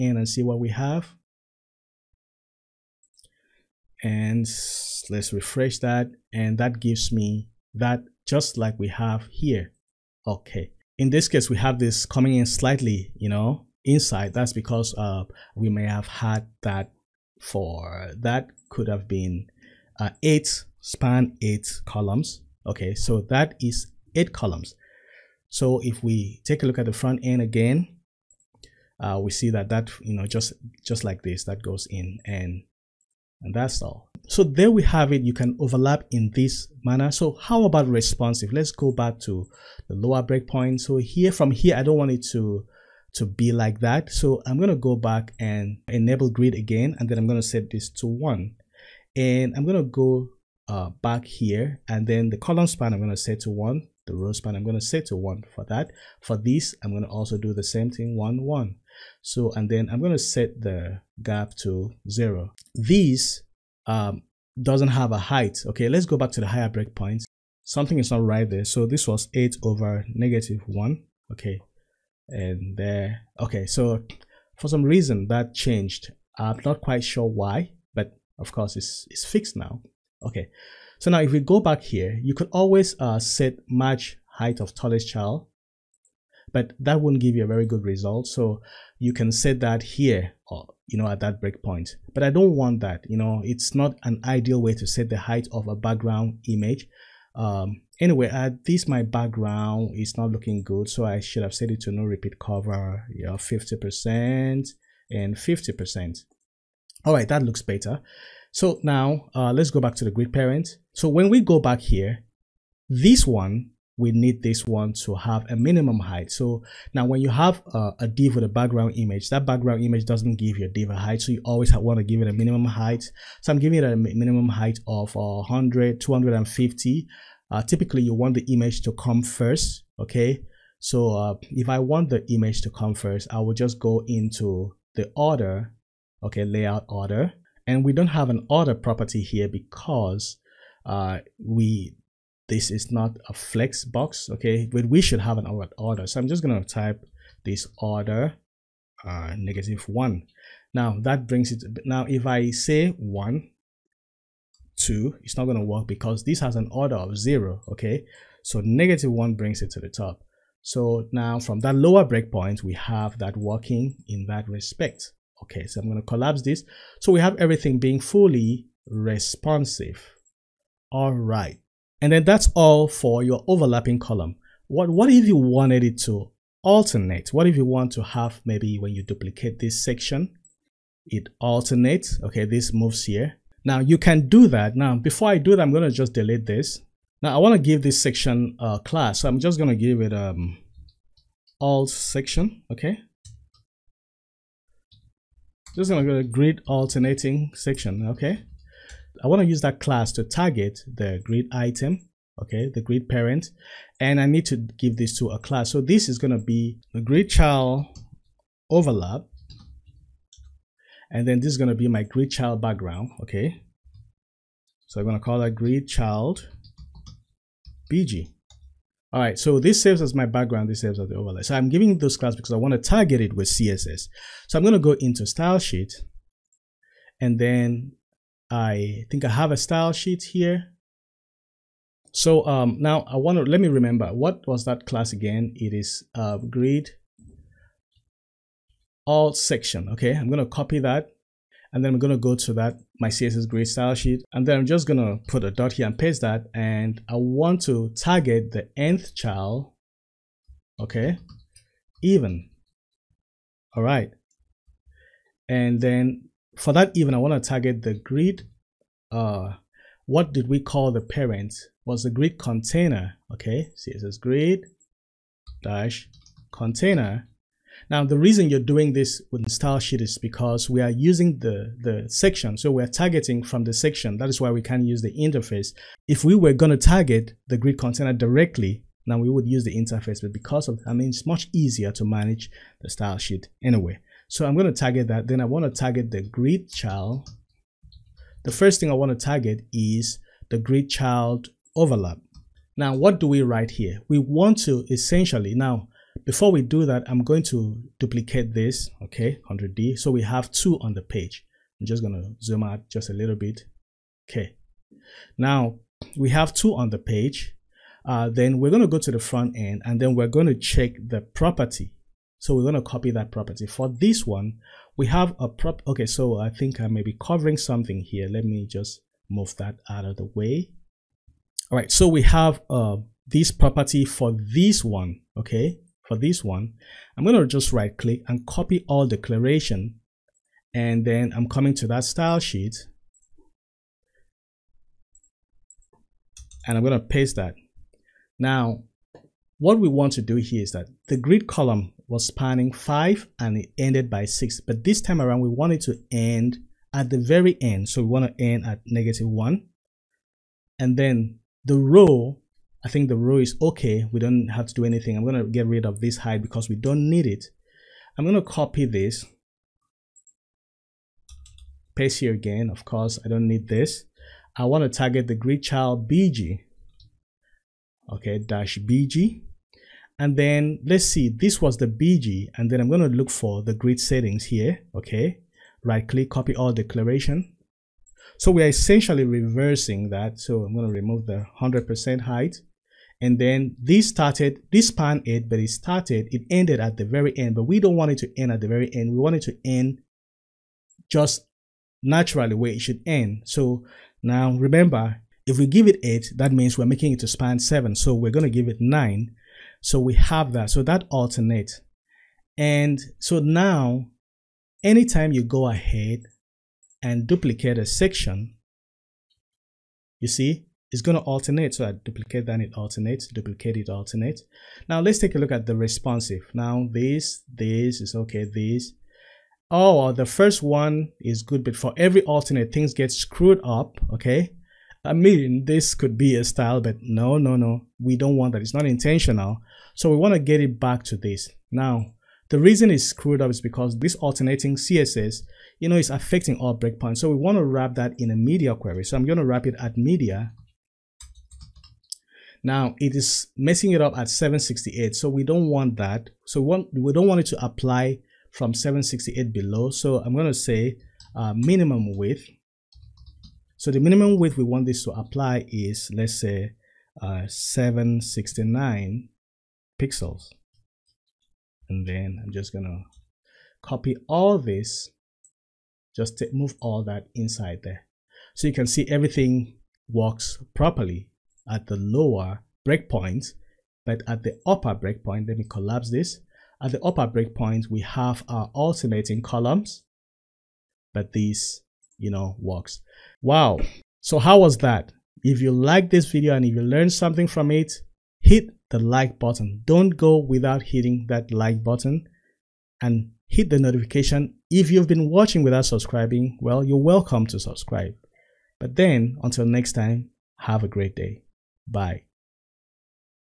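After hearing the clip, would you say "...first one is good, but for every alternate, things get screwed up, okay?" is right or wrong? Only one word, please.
right.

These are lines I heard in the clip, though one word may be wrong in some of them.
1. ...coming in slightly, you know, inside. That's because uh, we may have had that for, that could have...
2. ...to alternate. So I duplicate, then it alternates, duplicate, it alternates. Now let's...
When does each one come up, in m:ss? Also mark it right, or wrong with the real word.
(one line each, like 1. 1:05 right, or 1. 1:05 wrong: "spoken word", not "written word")
1. 0:12 right
2. 6:51 right.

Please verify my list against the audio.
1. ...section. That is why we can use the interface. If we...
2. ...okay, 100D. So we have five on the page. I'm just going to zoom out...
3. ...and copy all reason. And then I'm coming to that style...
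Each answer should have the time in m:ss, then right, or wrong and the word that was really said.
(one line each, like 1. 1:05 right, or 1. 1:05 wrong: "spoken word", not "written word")
1. 4:33 right
2. 4:59 wrong: "two", not "five"
3. 5:28 wrong: "declaration", not "reason".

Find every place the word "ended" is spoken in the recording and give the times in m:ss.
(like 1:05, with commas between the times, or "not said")
5:43, 6:26.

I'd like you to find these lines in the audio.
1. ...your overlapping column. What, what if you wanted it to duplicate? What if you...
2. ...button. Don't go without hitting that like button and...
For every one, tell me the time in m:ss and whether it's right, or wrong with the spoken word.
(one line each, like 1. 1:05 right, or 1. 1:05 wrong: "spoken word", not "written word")
1. 2:53 wrong: "alternate", not "duplicate"
2. 8:09 right.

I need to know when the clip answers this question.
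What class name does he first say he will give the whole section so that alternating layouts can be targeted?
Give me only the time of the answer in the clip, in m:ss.
3:11.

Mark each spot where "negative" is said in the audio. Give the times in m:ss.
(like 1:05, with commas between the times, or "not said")
1:10, 2:29, 2:38, 5:48.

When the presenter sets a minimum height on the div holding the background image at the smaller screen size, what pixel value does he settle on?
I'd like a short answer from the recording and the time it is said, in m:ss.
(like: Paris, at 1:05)
250, at 2:05.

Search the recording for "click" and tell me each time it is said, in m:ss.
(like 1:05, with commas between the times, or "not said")
5:27, 6:16.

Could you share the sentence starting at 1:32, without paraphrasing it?
But I don't want that, you know, it's not an ideal way to set the height of a background image.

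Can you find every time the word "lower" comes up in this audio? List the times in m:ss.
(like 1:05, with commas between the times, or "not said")
0:39, 2:41, 7:51.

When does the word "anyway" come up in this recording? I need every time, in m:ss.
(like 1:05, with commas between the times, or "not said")
1:37, 4:43.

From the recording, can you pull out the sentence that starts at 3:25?
So this is going to be the grid child overlap, and then this is going to be my grid child background, okay.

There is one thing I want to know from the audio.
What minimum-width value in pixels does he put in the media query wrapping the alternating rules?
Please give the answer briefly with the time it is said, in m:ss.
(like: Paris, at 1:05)
769, at 7:37.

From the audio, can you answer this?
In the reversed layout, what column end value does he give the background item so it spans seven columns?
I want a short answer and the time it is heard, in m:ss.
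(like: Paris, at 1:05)
9, at 6:38.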